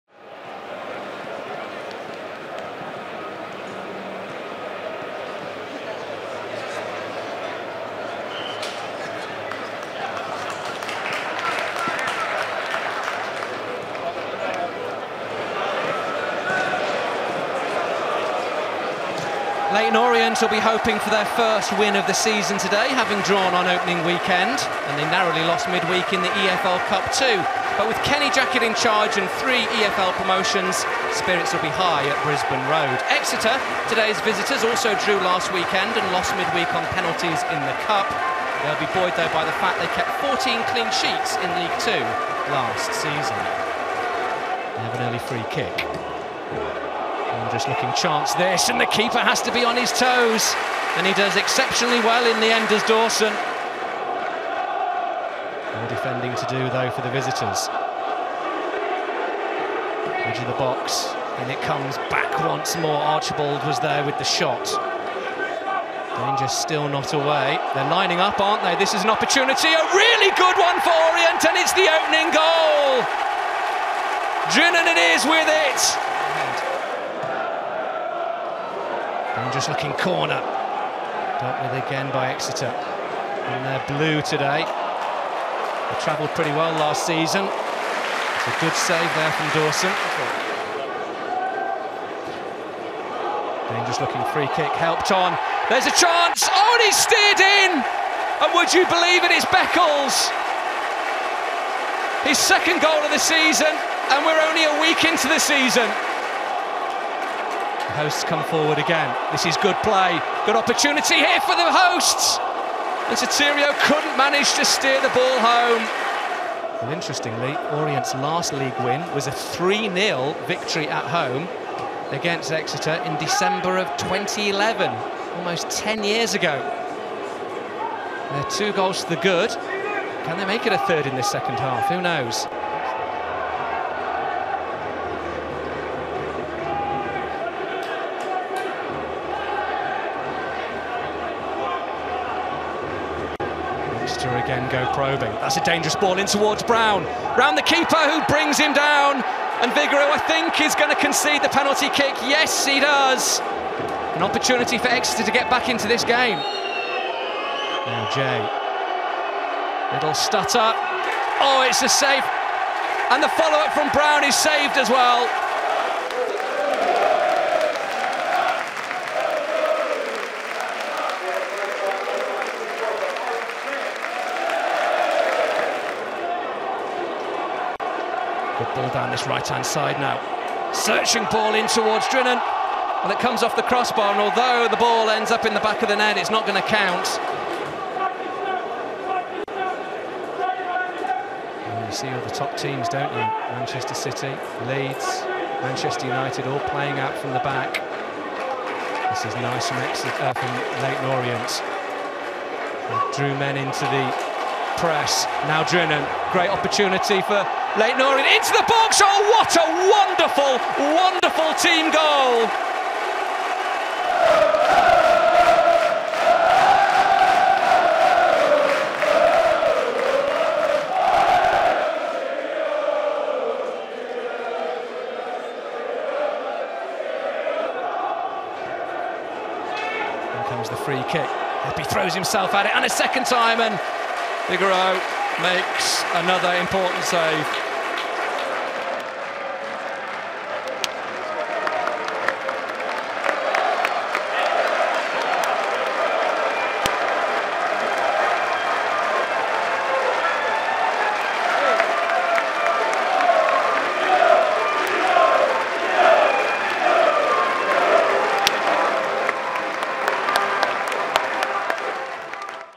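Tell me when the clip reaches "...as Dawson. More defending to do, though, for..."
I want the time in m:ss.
0:52.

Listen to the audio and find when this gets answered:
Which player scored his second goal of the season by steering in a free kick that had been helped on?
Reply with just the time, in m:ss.
1:39.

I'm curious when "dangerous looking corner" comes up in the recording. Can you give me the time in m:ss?
1:19.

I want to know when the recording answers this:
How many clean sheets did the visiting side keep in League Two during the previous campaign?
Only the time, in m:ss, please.
0:40.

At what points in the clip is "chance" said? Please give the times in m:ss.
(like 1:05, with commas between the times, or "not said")
0:47, 1:35.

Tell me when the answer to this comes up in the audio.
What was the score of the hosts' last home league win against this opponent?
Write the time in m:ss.
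1:59.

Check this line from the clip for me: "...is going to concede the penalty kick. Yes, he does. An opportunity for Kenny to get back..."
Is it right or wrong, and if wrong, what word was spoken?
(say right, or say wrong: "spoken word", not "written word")
wrong: "Exeter", not "Kenny".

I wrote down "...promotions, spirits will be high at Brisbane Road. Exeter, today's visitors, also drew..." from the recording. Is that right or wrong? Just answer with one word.
right.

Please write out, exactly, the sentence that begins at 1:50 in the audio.
Good opportunity here for the hosts.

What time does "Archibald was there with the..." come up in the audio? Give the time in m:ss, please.
1:02.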